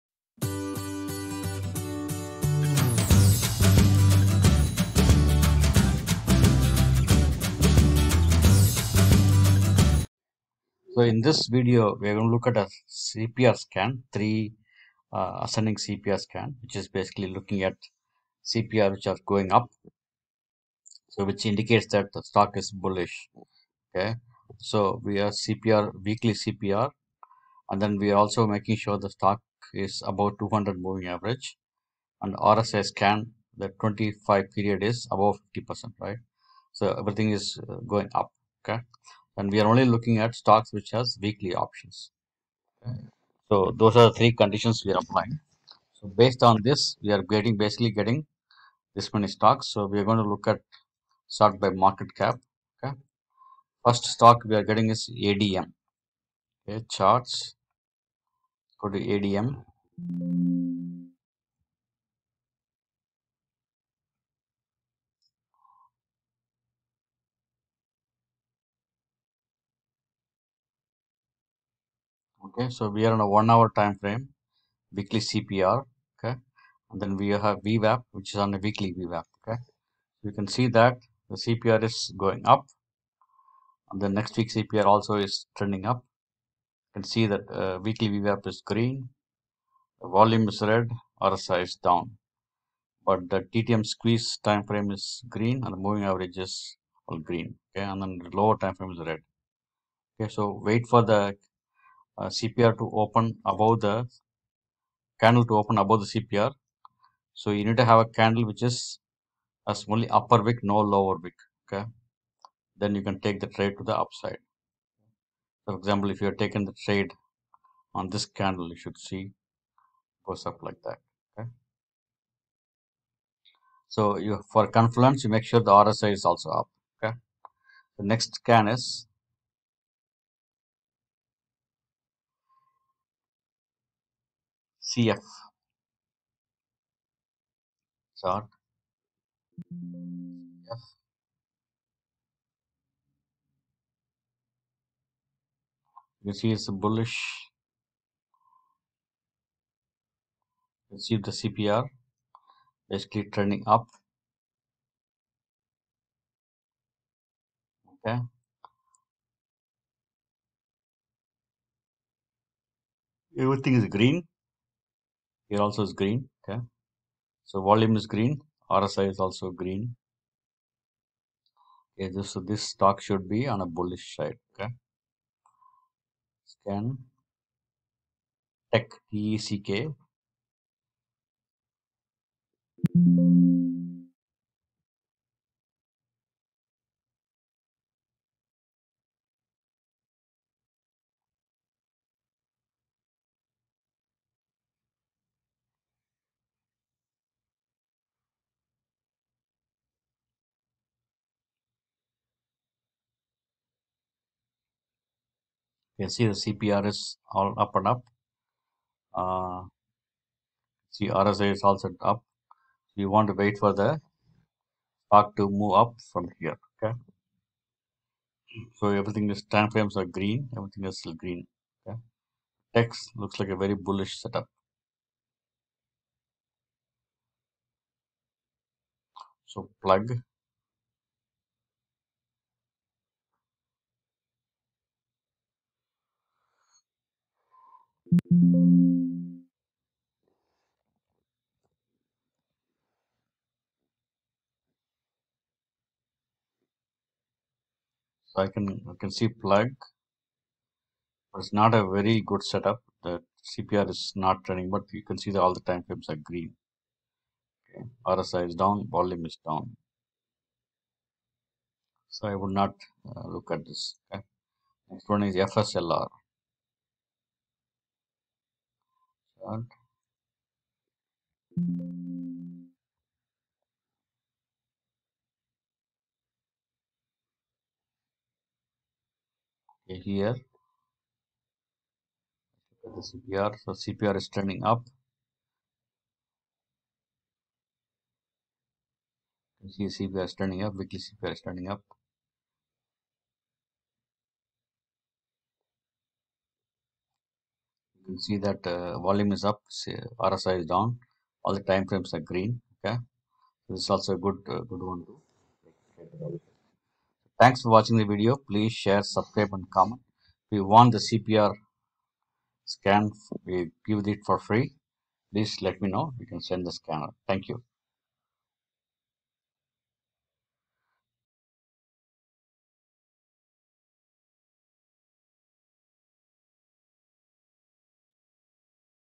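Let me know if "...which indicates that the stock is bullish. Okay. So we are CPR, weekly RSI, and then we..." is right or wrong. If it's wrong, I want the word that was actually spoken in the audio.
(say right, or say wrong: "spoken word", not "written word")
wrong: "CPR", not "RSI".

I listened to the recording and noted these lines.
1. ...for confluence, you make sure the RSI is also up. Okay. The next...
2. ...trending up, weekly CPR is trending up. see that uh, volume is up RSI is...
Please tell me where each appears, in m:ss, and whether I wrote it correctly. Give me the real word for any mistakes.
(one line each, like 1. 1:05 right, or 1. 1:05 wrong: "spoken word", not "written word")
1. 2:04 right
2. 4:50 right.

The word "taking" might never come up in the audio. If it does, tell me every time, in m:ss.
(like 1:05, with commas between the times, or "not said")
1:56.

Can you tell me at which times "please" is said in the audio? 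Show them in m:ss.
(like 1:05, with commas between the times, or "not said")
5:08, 5:15.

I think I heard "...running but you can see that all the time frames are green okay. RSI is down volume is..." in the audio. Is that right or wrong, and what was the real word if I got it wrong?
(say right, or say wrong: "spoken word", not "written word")
right.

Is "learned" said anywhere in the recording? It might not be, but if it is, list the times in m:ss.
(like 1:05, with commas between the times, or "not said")
not said.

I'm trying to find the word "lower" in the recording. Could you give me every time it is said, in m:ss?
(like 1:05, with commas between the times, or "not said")
1:38, 1:50.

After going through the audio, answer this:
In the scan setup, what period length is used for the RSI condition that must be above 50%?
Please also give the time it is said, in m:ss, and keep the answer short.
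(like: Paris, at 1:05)
25, at 0:33.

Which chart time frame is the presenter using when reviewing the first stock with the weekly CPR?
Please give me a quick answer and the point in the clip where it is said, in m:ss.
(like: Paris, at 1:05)
One hour, at 1:13.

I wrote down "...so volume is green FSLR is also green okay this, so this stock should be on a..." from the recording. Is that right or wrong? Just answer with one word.
wrong.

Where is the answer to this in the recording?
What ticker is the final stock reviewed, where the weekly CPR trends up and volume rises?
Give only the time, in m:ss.
4:25.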